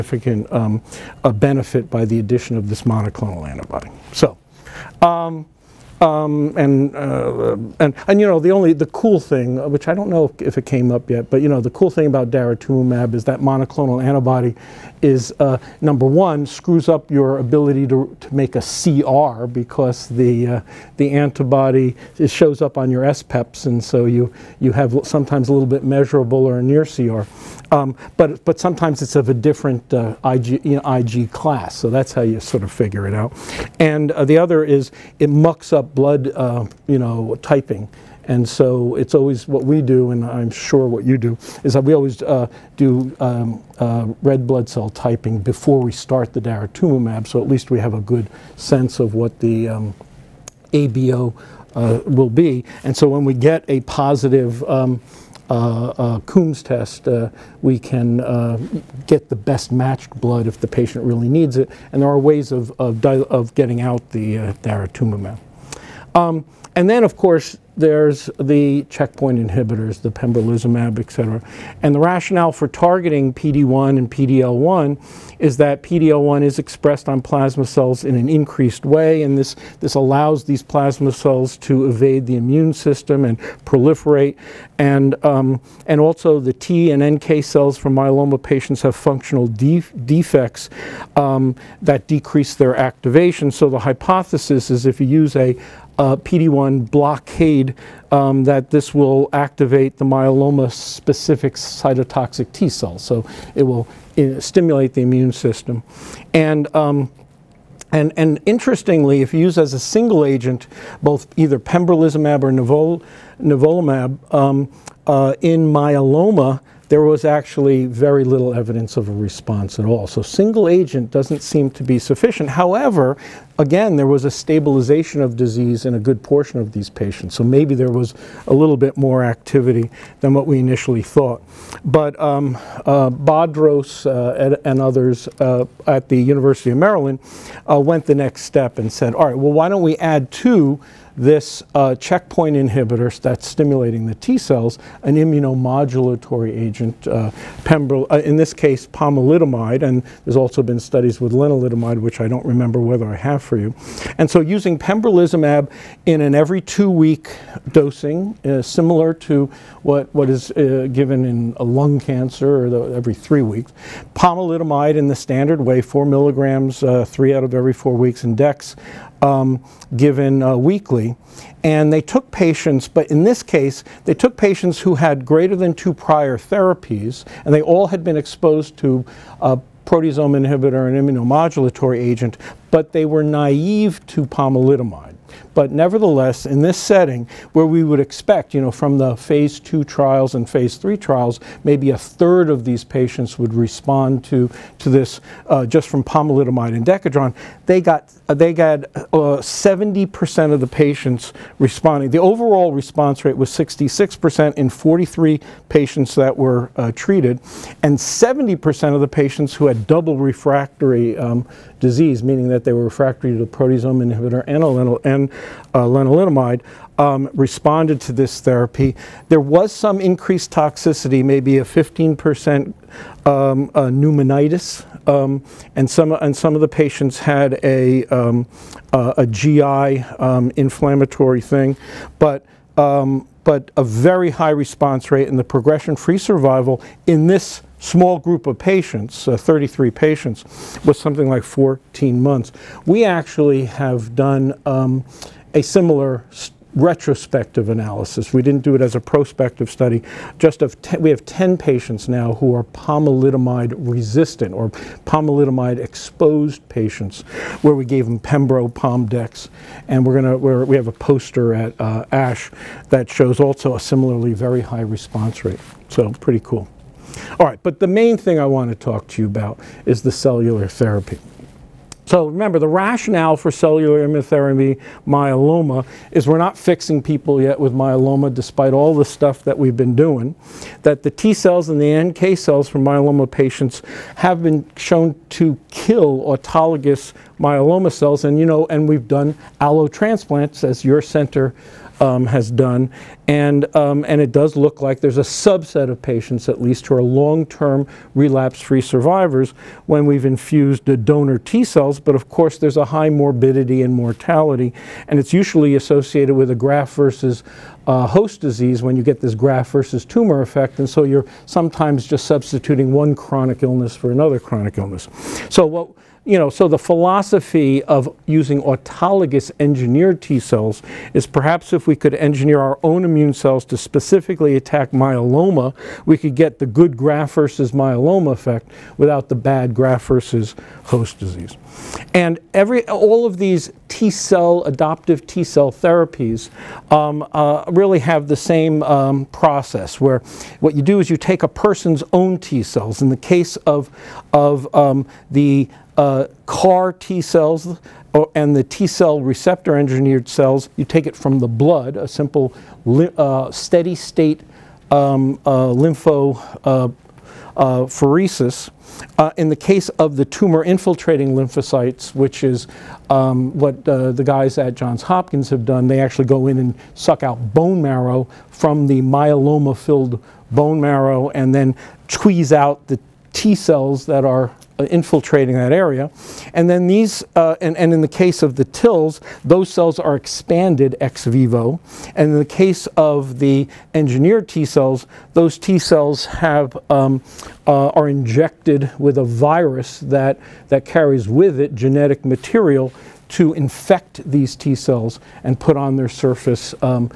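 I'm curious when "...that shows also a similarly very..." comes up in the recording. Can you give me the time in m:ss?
4:22.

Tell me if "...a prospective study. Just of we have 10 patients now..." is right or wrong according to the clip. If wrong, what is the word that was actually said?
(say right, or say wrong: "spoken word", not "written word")
right.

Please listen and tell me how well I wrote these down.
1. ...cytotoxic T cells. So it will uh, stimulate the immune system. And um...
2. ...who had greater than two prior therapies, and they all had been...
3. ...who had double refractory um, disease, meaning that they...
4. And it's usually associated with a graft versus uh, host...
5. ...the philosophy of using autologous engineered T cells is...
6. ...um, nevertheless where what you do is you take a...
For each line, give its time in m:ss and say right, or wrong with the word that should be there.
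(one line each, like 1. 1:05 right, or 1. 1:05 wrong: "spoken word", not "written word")
1. 1:41 right
2. 2:54 right
3. 3:29 right
4. 5:05 right
5. 5:16 right
6. 5:38 wrong: "process", not "nevertheless".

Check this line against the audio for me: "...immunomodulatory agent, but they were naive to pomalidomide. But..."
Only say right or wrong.
right.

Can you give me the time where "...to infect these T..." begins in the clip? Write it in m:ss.
6:33.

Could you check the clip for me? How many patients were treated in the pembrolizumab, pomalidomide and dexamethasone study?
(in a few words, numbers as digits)
43.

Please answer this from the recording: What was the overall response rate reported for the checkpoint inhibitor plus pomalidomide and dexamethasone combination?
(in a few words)
66%.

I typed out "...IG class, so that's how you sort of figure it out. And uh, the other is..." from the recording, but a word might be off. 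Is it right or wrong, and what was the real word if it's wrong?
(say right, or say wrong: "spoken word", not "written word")
right.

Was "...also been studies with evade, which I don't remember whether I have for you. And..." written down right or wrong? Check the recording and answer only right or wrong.
wrong.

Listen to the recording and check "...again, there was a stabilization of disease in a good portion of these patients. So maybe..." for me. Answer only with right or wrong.
right.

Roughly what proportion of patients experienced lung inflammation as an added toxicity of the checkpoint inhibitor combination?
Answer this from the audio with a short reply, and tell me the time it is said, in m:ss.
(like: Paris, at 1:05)
15%, at 3:41.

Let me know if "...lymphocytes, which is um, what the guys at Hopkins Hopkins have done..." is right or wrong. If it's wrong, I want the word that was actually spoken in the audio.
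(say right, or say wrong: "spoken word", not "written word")
wrong: "Johns", not "Hopkins".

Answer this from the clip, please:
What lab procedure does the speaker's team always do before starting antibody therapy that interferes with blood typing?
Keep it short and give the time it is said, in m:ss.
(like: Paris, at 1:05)
red blood cell typing, at 0:44.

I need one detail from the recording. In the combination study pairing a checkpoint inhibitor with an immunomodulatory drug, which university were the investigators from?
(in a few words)
University of Maryland.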